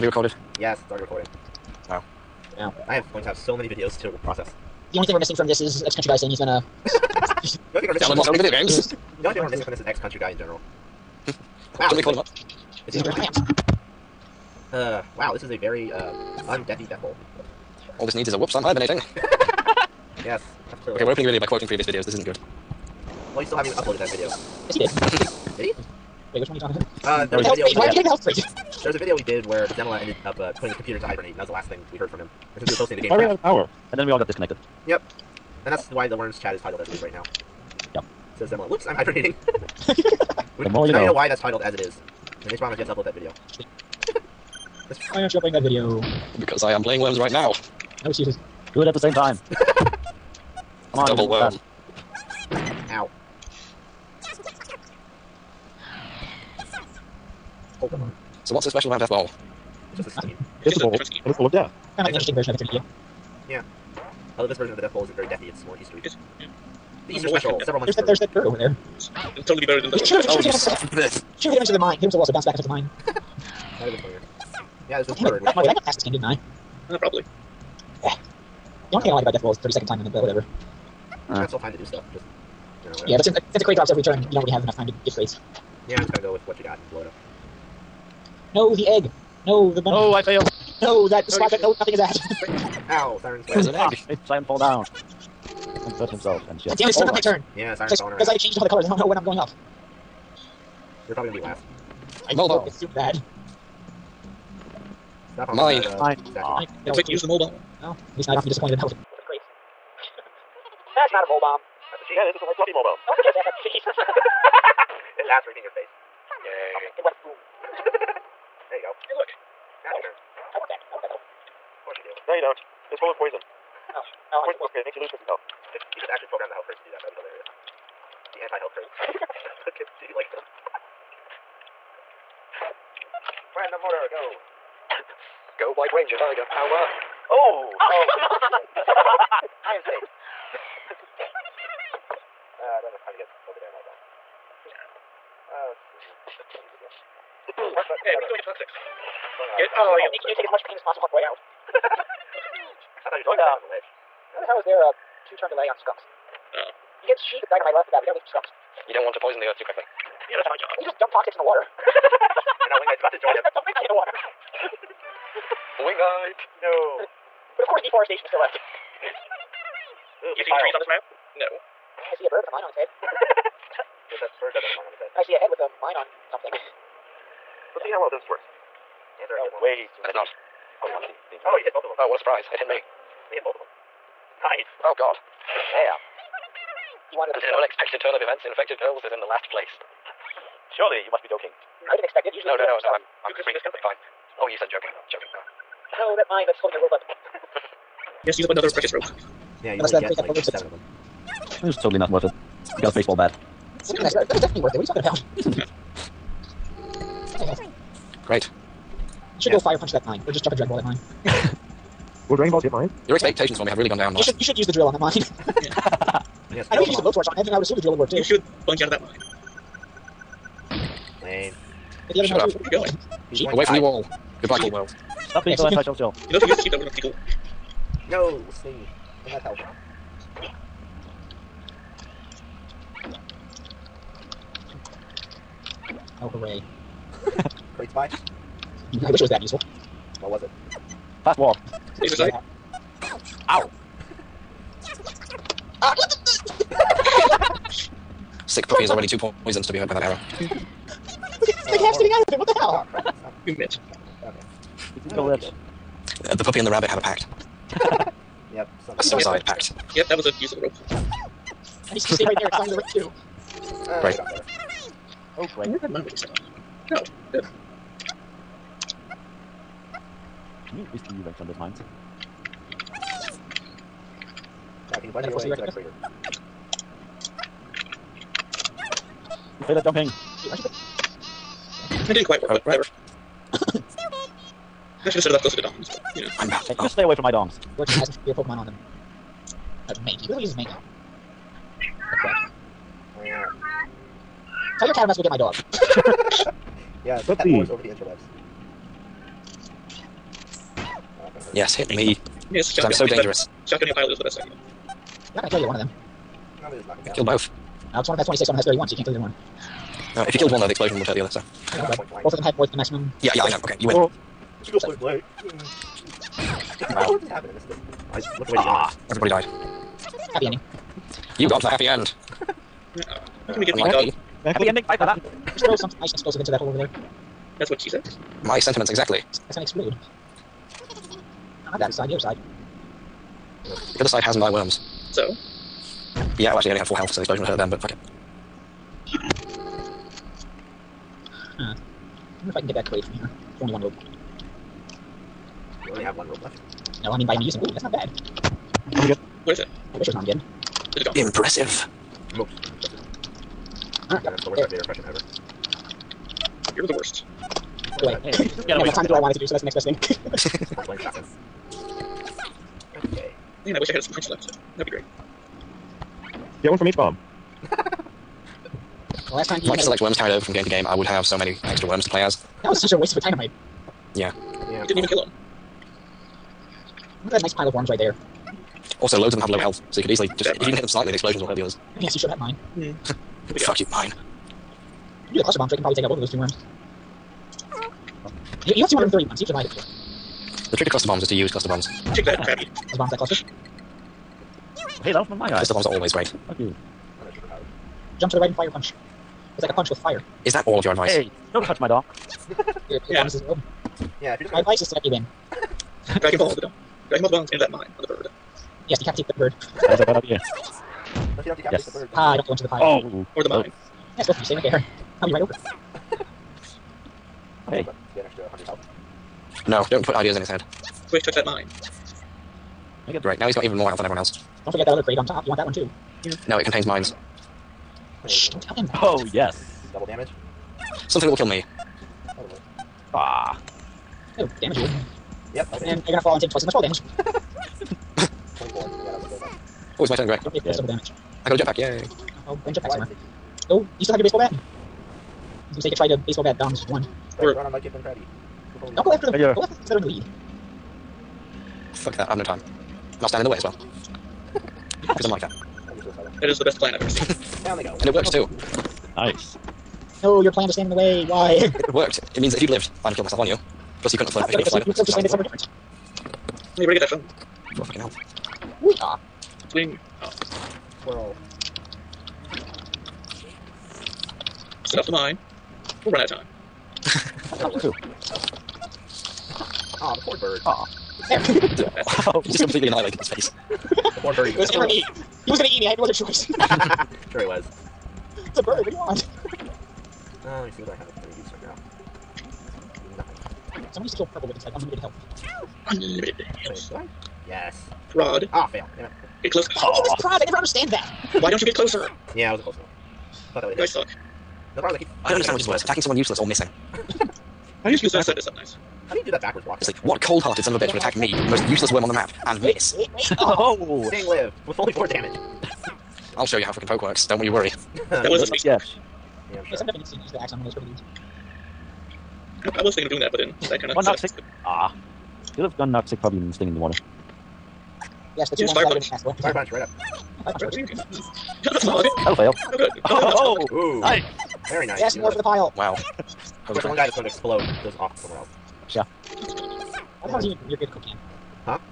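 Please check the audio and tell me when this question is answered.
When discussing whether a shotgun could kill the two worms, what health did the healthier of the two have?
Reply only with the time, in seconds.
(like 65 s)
308 s.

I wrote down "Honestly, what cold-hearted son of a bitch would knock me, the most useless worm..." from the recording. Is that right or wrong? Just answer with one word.
wrong.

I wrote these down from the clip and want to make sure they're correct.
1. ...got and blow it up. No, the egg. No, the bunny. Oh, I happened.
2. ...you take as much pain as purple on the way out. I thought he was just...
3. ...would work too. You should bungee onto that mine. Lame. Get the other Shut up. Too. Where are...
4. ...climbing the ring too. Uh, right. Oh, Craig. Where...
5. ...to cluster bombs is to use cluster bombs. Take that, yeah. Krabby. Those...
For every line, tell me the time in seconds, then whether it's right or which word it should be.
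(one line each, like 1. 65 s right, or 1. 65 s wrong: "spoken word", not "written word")
1. 86 s wrong: "failed", not "happened"
2. 150 s wrong: "possible", not "purple"
3. 217 s right
4. 262 s right
5. 390 s right.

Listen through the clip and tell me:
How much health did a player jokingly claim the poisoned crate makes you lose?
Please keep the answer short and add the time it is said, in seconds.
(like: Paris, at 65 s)
50, at 125 s.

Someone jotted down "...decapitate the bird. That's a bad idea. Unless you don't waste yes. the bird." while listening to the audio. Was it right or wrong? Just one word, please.
wrong.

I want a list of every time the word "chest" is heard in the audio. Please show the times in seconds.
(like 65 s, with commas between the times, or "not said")
not said.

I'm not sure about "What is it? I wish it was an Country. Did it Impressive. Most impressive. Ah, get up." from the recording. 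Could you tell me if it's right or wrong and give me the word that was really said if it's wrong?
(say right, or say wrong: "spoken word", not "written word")
wrong: "Armageddon", not "Country".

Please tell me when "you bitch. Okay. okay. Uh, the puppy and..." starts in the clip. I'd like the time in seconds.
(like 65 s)
253 s.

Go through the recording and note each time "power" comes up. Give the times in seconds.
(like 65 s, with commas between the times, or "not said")
33 s, 136 s.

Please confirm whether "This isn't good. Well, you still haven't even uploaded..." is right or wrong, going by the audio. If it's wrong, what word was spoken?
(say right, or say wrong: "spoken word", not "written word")
right.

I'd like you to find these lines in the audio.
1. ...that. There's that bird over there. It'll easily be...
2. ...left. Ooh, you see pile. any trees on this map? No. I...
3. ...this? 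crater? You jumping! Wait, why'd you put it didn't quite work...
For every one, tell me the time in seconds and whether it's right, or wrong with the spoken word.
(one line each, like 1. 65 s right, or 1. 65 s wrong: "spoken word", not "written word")
1. 67 s wrong: "totally", not "easily"
2. 168 s right
3. 275 s right.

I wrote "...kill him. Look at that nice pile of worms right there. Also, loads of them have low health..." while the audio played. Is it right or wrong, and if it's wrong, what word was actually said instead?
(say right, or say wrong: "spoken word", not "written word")
right.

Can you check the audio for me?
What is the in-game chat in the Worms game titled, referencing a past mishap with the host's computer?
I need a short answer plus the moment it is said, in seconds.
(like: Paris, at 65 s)
Zemela. Whoops! I'm hibernating., at 38 s.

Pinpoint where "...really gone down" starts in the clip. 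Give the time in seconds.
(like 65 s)
213 s.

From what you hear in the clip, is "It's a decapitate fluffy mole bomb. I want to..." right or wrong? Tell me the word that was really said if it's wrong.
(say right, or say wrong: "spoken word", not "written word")
wrong: "white", not "decapitate".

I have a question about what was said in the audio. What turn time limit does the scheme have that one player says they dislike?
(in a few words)
30 seconds.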